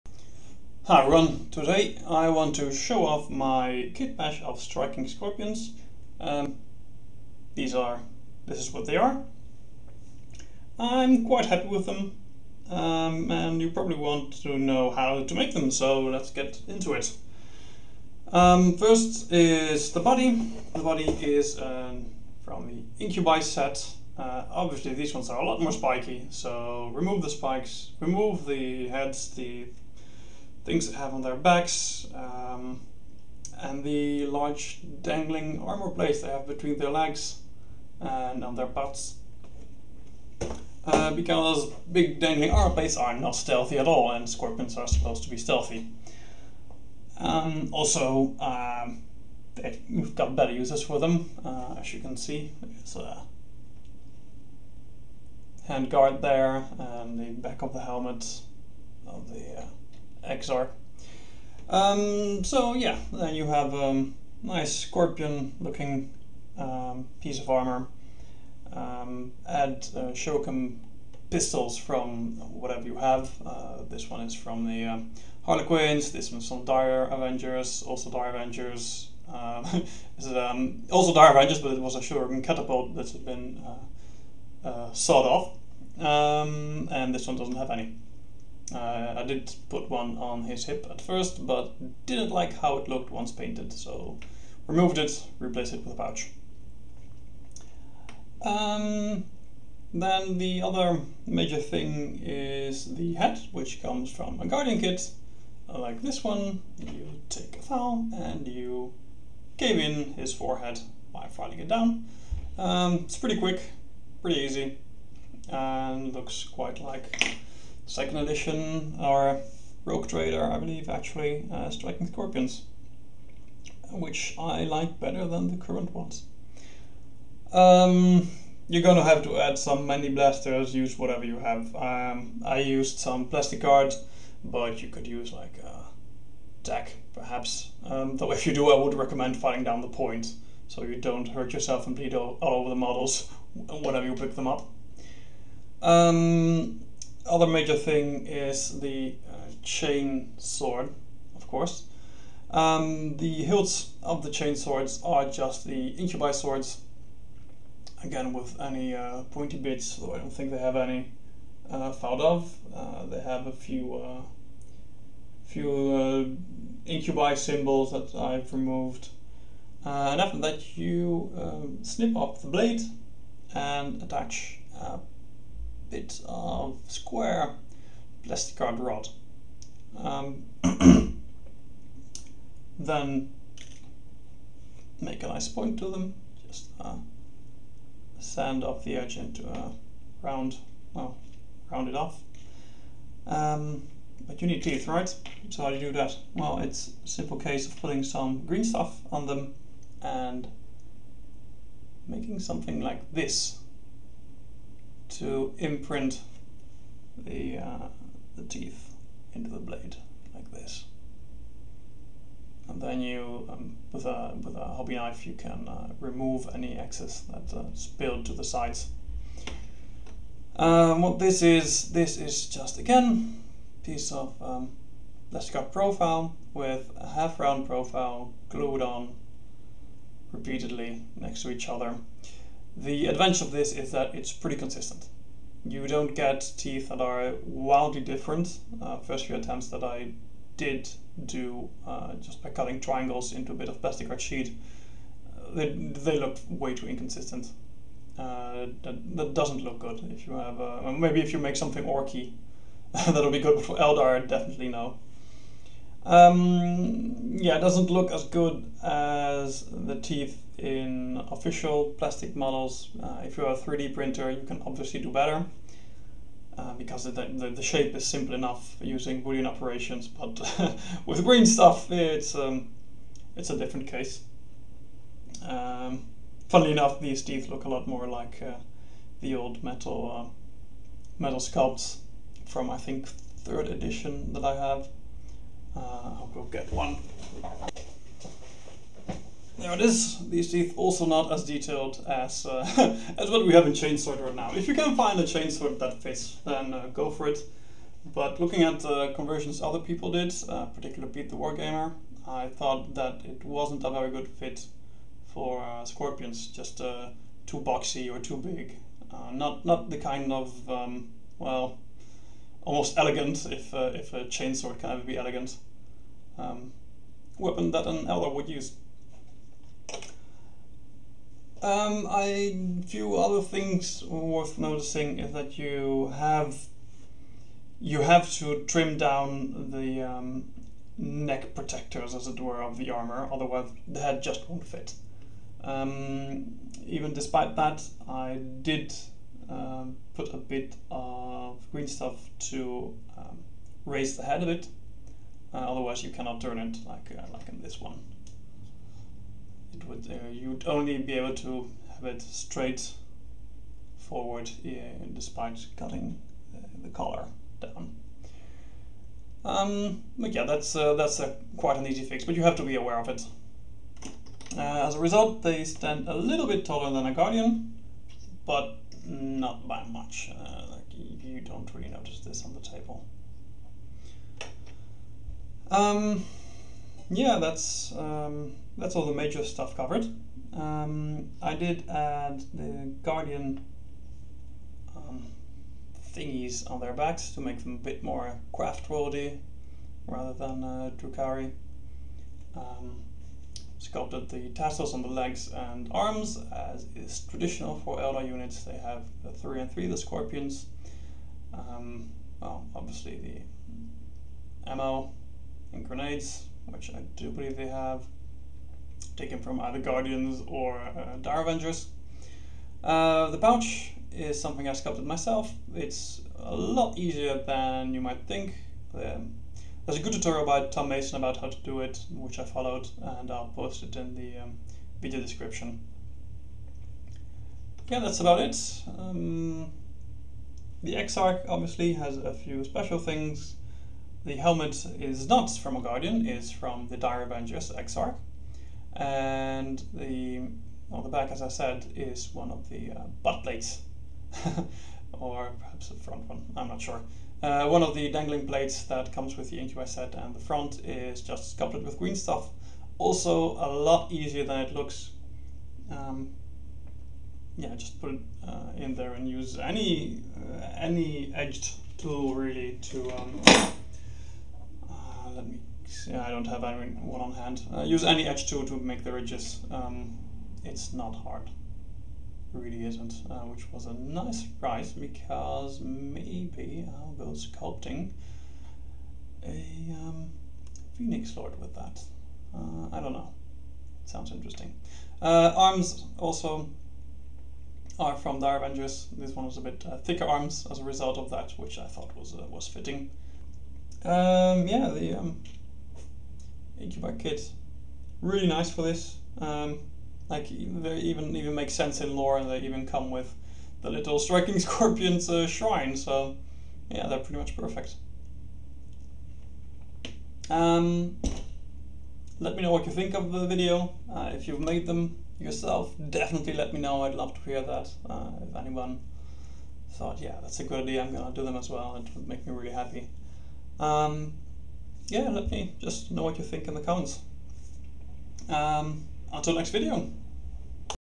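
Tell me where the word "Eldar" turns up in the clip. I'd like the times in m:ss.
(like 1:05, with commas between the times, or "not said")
4:13, 5:18, 6:37.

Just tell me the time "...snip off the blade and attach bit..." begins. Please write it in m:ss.
2:51.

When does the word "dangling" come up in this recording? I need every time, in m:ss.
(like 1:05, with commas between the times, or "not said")
0:35, 0:42, 7:28.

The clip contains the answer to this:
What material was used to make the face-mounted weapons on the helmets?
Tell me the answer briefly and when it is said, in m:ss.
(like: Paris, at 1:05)
Plastic cards, at 2:13.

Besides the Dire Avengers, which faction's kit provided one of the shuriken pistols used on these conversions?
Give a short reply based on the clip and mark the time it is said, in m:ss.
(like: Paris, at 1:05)
Harlequins, at 1:15.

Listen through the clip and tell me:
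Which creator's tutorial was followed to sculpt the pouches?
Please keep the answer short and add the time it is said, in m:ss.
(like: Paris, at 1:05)
Tom Mason, at 7:00.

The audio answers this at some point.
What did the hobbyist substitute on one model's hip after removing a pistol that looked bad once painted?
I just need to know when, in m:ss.
1:35.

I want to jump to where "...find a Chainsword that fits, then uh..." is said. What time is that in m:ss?
4:54.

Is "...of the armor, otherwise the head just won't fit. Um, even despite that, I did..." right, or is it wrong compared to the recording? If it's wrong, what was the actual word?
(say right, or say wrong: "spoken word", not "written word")
right.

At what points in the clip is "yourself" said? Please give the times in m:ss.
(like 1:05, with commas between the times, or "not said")
2:21, 8:35.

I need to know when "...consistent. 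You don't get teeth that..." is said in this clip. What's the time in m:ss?
3:54.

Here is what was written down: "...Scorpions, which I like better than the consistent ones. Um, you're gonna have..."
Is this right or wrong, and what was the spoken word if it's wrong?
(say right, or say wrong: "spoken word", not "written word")
wrong: "current", not "consistent".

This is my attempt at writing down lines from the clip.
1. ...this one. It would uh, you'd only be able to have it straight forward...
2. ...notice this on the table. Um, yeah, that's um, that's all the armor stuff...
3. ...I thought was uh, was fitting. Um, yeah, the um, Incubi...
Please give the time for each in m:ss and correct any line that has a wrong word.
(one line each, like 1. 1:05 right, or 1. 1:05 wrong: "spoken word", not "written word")
1. 5:47 right
2. 6:11 wrong: "major", not "armor"
3. 8:11 right.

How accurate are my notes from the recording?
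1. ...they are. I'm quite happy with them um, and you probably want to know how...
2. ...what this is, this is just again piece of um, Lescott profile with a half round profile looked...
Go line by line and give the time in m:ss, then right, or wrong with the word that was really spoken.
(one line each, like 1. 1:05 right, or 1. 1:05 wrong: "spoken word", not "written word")
1. 0:08 right
2. 3:41 wrong: "glued", not "looked".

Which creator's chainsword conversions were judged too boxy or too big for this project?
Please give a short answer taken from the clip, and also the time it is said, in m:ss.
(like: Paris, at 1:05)
Pete the Wargamer, at 5:01.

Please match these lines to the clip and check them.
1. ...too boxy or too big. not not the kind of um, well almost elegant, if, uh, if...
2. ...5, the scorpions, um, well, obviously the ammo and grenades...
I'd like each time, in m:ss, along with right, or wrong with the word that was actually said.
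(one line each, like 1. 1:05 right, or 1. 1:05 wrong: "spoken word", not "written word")
1. 5:07 right
2. 6:39 wrong: "3", not "5".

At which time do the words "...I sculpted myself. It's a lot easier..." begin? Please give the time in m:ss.
6:54.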